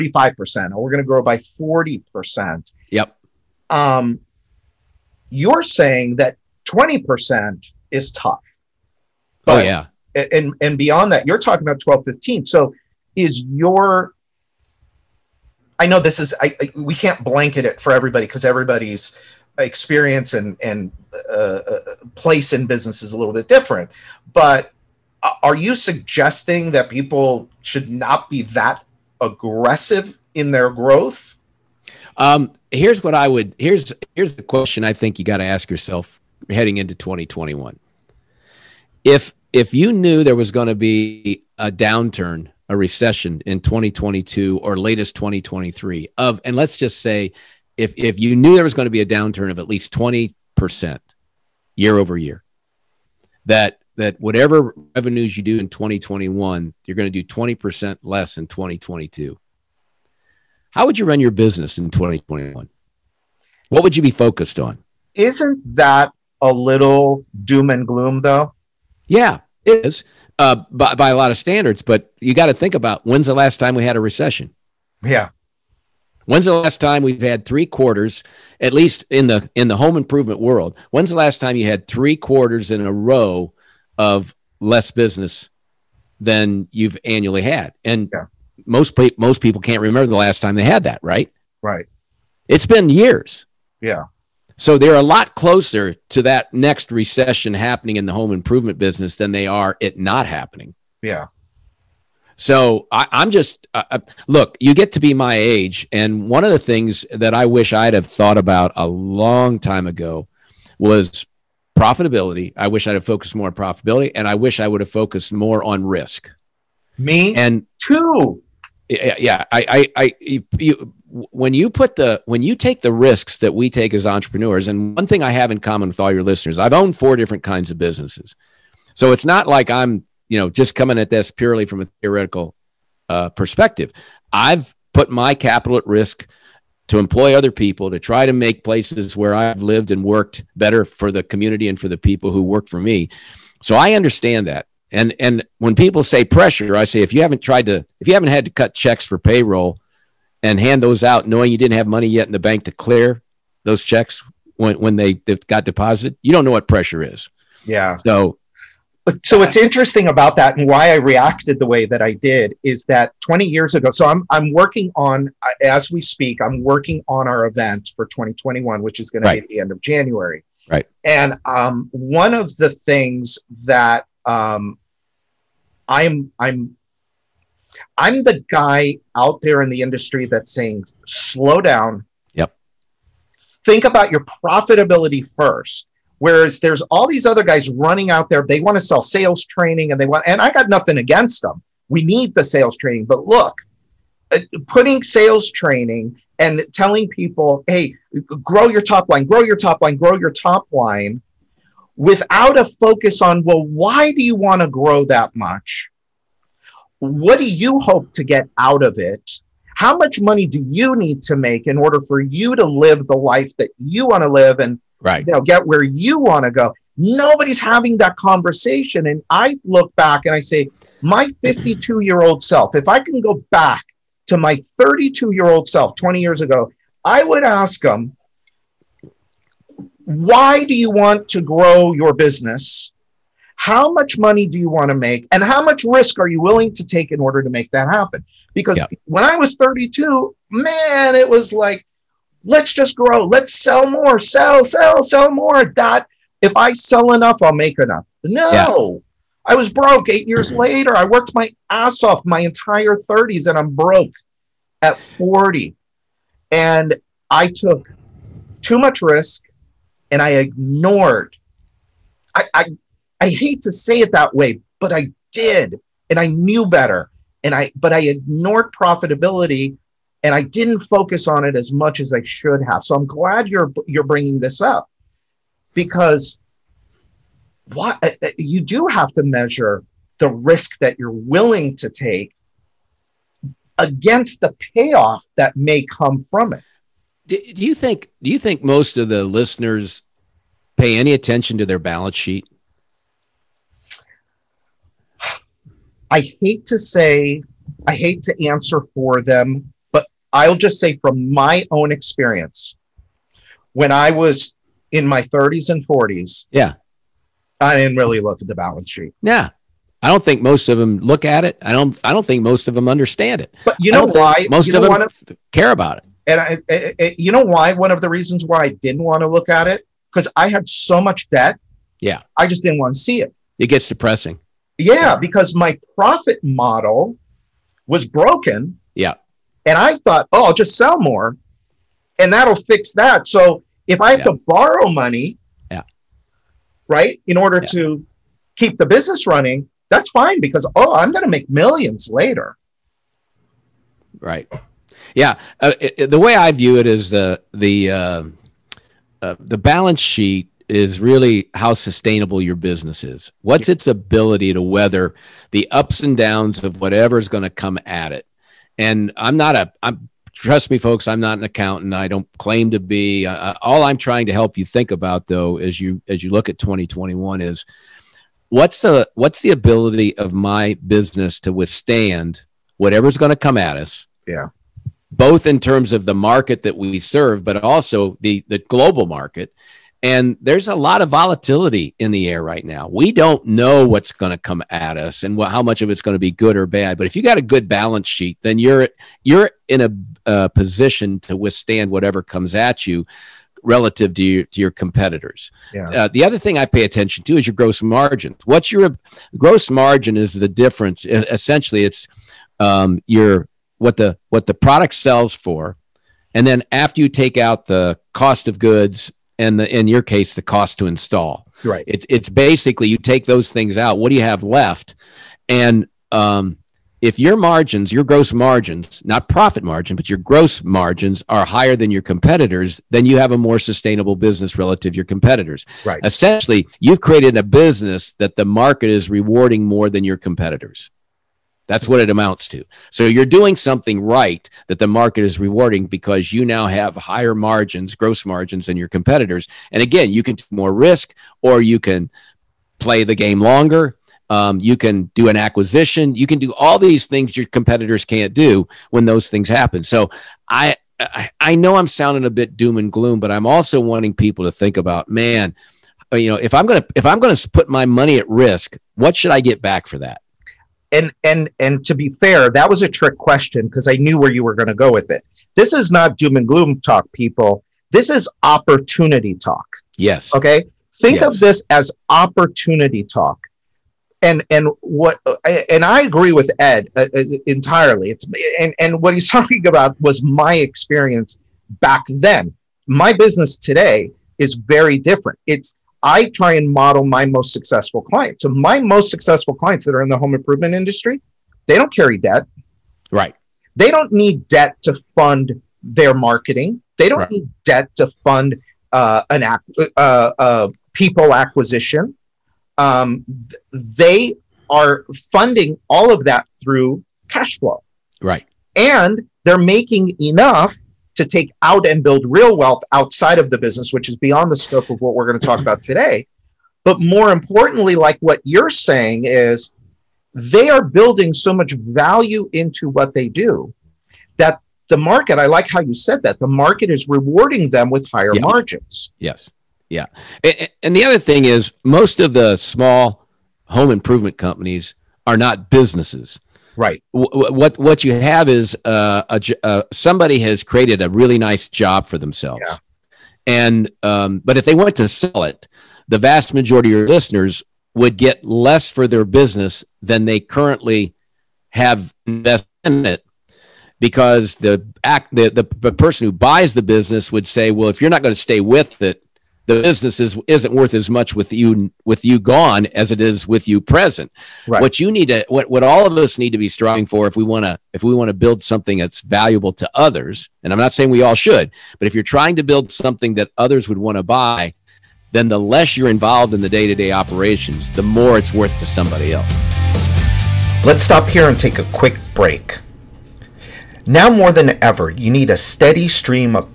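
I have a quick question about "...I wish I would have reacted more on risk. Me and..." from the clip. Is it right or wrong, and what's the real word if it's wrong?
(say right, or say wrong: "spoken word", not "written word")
wrong: "focused", not "reacted".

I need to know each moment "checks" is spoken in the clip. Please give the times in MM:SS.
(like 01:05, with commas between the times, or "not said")
02:28, 02:33.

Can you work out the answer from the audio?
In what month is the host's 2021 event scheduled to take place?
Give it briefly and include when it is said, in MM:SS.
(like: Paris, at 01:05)
January, at 02:49.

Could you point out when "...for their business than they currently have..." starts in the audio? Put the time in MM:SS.
09:08.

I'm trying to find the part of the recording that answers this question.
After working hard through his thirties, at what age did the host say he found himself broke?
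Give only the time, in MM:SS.
04:13.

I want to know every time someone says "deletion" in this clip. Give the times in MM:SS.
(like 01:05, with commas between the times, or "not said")
not said.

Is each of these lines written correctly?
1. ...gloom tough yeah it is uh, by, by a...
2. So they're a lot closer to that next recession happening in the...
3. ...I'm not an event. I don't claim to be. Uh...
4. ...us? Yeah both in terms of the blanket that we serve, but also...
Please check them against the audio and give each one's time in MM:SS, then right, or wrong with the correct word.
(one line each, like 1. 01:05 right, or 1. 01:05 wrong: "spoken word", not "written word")
1. 01:07 wrong: "though", not "tough"
2. 01:34 right
3. 06:01 wrong: "accountant", not "event"
4. 06:13 wrong: "market", not "blanket".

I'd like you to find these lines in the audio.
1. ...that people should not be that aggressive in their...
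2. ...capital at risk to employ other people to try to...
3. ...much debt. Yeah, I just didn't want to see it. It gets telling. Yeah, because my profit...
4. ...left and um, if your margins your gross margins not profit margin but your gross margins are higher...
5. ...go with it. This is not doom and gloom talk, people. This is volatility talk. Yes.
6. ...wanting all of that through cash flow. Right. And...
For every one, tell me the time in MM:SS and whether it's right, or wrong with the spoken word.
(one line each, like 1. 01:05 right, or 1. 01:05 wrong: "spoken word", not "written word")
1. 00:26 right
2. 02:15 right
3. 05:20 wrong: "depressing", not "telling"
4. 06:54 right
5. 07:44 wrong: "opportunity", not "volatility"
6. 08:25 wrong: "funding", not "wanting".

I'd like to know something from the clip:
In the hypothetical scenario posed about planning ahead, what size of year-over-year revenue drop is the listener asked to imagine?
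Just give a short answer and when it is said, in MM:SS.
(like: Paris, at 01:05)
20%, at 00:49.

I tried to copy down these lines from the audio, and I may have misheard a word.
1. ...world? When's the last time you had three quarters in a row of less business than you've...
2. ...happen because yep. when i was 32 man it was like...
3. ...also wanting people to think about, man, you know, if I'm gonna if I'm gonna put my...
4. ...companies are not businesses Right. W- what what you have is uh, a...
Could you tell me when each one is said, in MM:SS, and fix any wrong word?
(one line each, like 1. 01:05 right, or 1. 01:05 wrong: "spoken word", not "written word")
1. 01:20 right
2. 03:57 right
3. 07:33 right
4. 08:54 right.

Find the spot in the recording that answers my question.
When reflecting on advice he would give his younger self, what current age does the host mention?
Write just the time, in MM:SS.
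03:41.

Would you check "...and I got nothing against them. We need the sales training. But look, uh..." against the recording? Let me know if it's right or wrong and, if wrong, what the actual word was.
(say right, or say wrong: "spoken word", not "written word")
right.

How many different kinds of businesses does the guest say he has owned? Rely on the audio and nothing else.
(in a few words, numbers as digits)
4.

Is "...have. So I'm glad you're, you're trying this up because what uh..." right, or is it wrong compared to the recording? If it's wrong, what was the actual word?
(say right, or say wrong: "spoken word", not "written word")
wrong: "bringing", not "trying".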